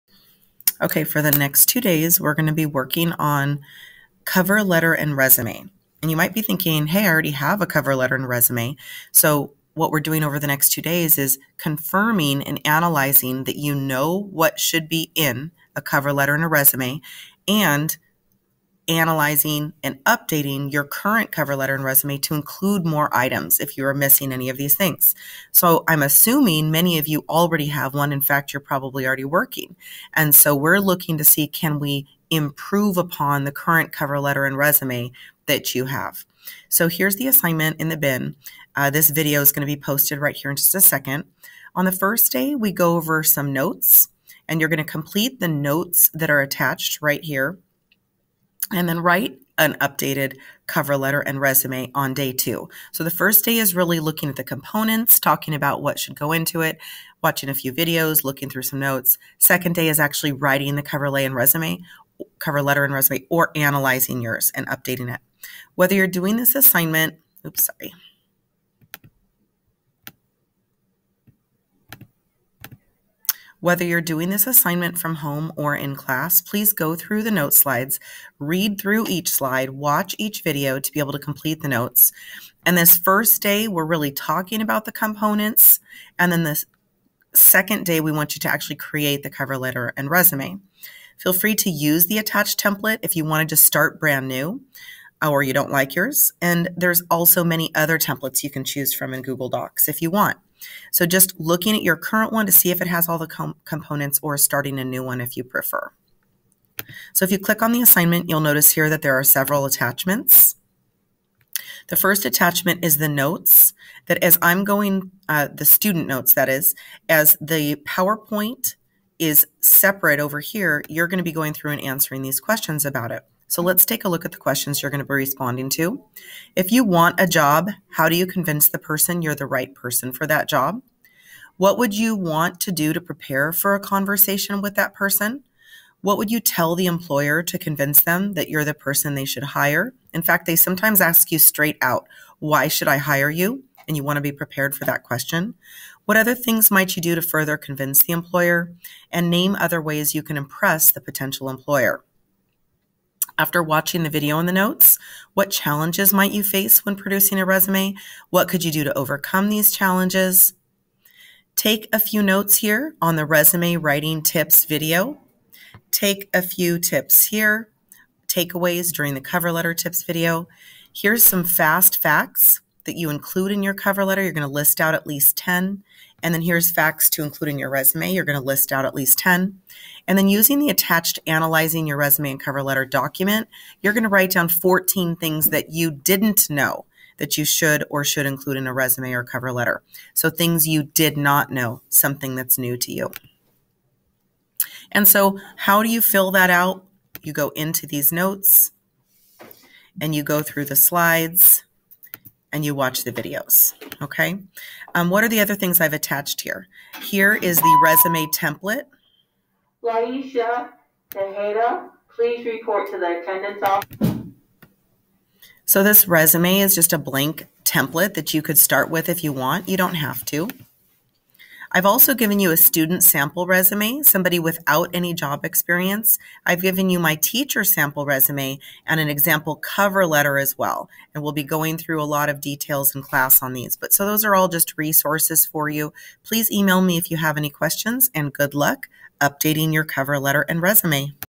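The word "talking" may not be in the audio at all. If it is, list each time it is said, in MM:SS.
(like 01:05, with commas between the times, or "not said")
00:55, 01:24.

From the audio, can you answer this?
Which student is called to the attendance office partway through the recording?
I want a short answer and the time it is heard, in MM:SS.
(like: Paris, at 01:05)
Laisha Tejeda, at 03:29.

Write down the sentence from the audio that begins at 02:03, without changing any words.
So let's take a look at the questions you're going to be responding to.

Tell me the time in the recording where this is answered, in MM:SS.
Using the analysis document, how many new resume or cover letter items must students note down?
03:04.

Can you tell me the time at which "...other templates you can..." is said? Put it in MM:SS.
01:37.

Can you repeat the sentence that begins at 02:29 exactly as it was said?
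And name other ways you can impress the potential employer.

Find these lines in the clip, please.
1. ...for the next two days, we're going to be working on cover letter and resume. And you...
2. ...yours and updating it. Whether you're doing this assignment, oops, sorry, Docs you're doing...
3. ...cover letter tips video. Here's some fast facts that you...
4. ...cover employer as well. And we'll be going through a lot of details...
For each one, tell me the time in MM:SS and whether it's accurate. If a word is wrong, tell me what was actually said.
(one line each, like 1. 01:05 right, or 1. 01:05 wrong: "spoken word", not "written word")
1. 00:01 right
2. 01:04 wrong: "Whether", not "Docs"
3. 02:49 right
4. 03:49 wrong: "letter", not "employer".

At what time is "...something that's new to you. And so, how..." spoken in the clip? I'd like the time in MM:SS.
03:11.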